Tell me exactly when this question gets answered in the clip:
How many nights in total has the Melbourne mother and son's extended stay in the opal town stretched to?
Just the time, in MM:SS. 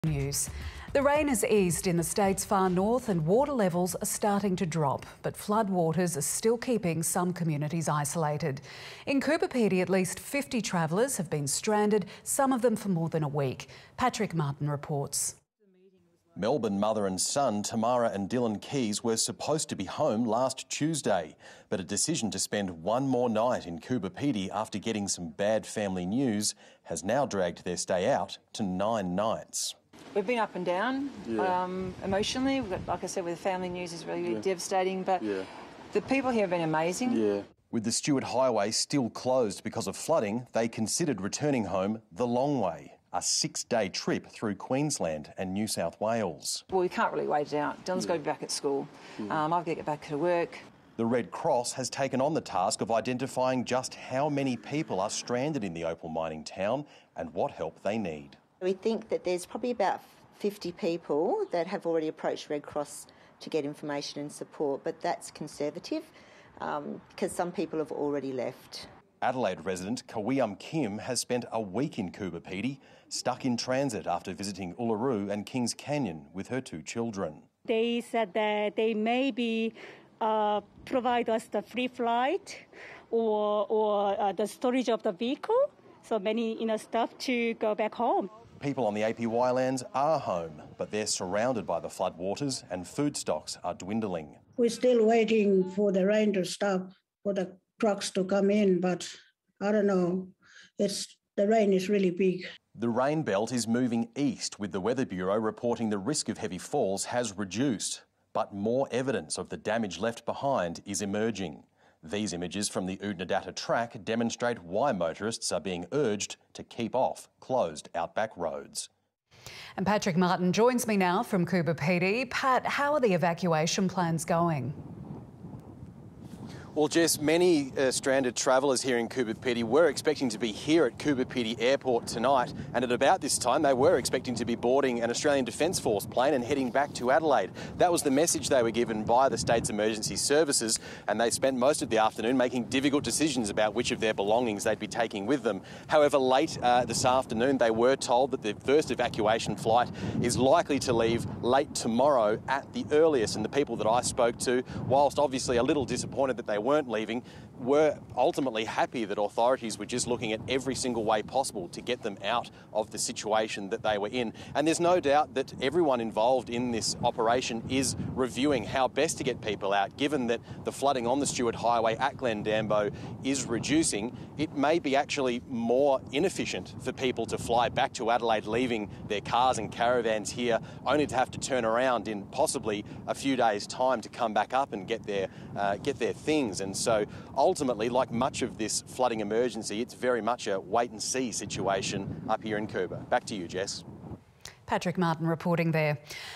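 00:28.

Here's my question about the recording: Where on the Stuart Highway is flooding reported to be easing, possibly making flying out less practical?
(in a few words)
Glendambo.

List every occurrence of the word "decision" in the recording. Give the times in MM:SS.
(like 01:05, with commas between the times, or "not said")
00:21, 02:23.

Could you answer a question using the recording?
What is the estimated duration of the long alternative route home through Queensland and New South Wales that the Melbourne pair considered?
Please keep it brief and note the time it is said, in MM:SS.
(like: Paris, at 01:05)
6 days, at 00:43.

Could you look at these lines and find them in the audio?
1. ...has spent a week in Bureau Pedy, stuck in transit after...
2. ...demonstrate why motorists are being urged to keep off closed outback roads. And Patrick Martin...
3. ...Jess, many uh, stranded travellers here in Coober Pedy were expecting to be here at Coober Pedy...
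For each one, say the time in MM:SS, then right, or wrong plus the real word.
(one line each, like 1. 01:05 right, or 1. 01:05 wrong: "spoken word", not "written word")
1. 01:10 wrong: "Coober", not "Bureau"
2. 01:54 right
3. 02:06 right.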